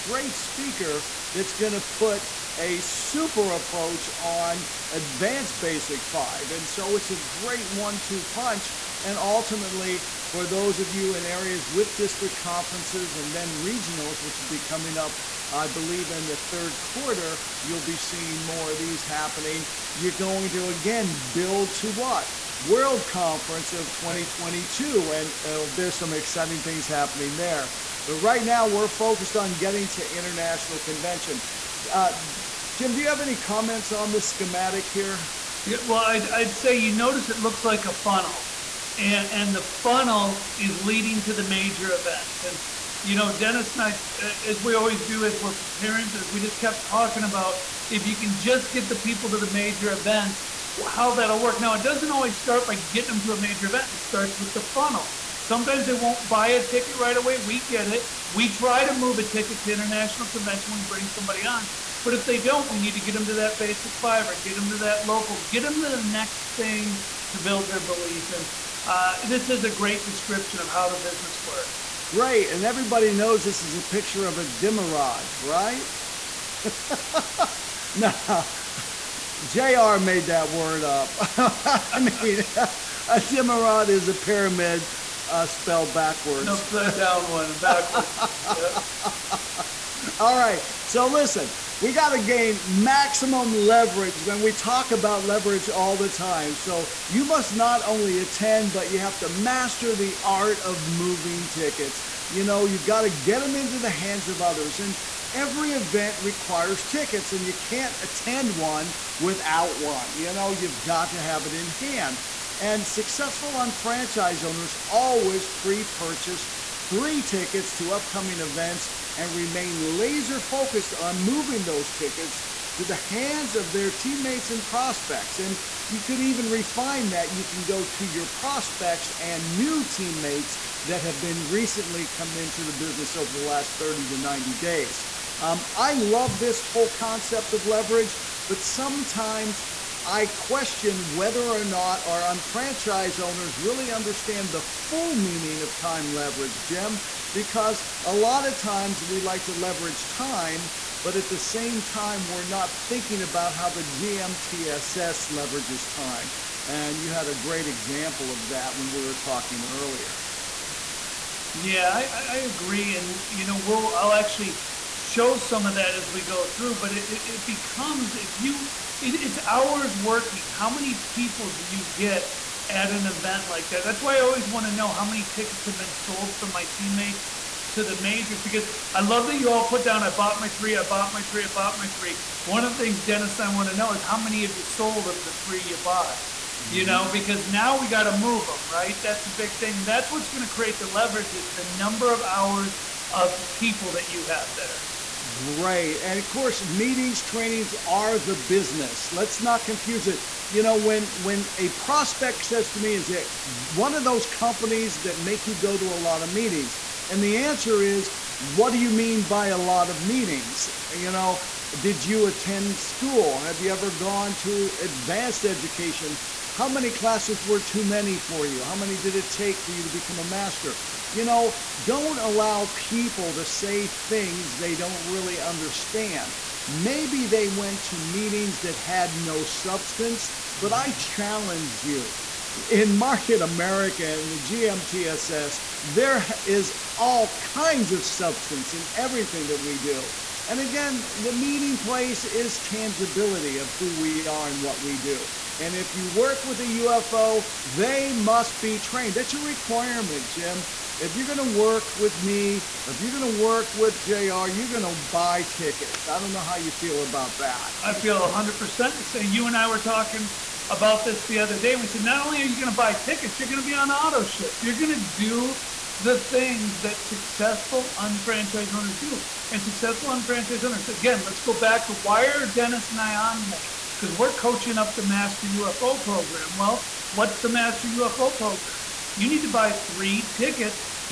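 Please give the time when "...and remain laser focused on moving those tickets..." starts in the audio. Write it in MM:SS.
01:59.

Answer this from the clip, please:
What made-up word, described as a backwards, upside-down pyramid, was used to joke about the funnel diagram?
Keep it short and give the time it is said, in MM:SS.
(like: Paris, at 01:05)
dimmerod, at 01:14.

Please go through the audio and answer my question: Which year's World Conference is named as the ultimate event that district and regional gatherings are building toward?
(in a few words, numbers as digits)
2022.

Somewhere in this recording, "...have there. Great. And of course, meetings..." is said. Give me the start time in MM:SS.
03:14.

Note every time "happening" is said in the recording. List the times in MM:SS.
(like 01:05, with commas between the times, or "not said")
00:19, 00:26.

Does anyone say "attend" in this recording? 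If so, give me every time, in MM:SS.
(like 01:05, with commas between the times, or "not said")
01:38, 01:48, 03:32.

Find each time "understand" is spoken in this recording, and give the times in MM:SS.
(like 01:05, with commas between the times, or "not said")
02:23, 03:45.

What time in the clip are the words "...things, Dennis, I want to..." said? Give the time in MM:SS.
03:02.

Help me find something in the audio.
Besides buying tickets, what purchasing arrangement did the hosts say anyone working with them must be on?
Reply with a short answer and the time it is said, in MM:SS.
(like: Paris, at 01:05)
auto ship, at 04:23.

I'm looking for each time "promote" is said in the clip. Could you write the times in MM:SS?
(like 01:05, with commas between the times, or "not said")
not said.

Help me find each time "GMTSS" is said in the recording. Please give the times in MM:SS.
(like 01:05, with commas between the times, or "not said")
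02:33, 03:54.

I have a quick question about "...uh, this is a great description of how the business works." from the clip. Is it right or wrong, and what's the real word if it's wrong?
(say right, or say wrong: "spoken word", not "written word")
right.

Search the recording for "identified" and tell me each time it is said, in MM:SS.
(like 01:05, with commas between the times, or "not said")
not said.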